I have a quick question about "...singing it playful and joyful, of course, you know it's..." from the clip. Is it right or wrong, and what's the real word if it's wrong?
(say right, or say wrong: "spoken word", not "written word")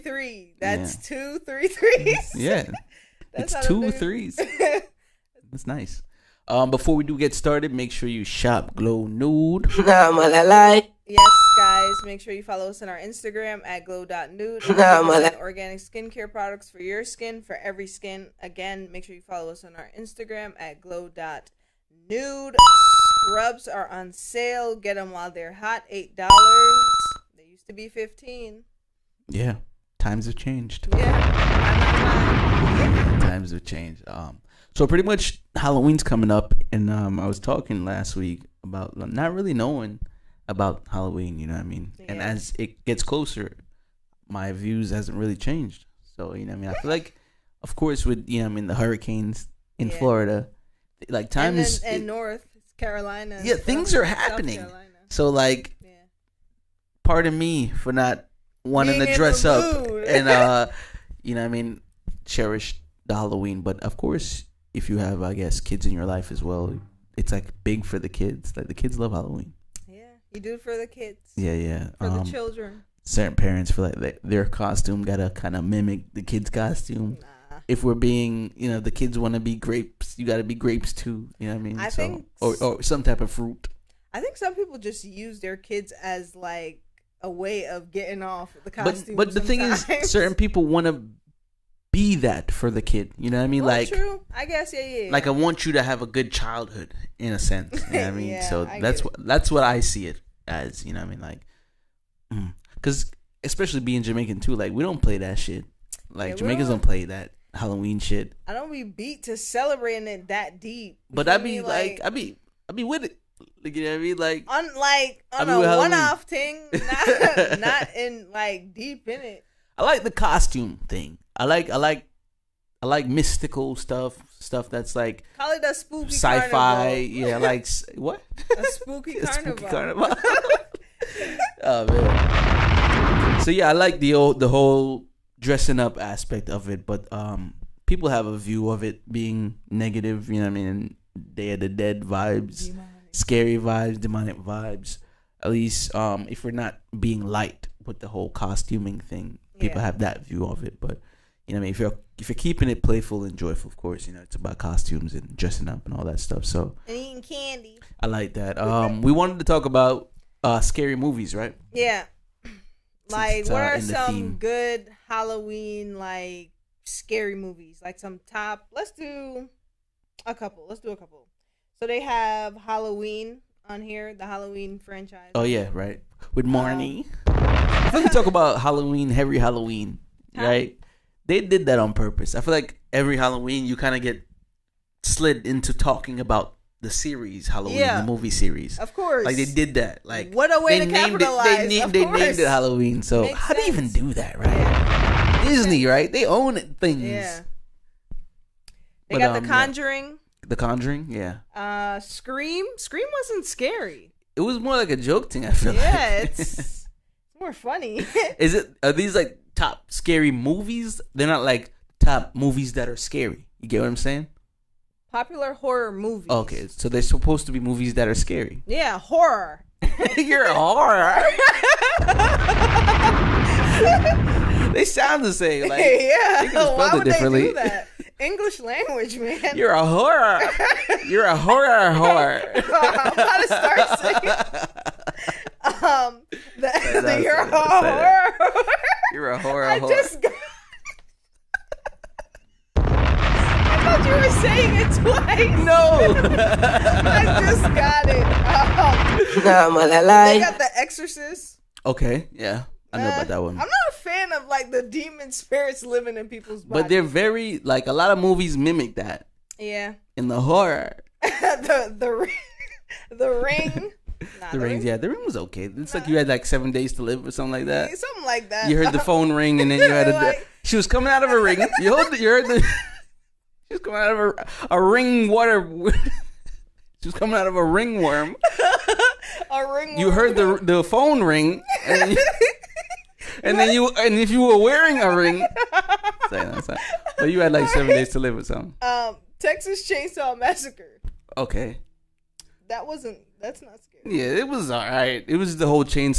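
wrong: "keeping", not "singing".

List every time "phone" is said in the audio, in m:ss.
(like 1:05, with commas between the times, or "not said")
4:28, 4:40.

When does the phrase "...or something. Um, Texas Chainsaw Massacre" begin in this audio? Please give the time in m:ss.
4:48.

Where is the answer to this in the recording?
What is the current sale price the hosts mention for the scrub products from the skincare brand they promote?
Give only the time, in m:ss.
0:25.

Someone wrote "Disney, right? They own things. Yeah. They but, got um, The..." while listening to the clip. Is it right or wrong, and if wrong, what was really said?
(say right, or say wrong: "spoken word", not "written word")
right.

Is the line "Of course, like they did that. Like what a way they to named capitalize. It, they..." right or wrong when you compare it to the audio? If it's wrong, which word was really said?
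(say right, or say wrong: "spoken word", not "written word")
right.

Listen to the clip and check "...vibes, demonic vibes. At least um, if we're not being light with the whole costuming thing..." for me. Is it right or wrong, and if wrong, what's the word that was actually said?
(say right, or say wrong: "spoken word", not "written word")
right.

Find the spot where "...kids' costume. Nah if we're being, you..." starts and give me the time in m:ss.
1:16.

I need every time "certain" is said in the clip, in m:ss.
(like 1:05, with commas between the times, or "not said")
1:13, 1:30.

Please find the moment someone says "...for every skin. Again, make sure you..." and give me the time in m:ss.
0:17.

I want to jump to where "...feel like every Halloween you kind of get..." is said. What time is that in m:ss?
3:02.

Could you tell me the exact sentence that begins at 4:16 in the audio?
But they're very like a lot of movies mimic that.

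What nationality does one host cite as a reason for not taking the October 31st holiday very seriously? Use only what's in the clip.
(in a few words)
Jamaican.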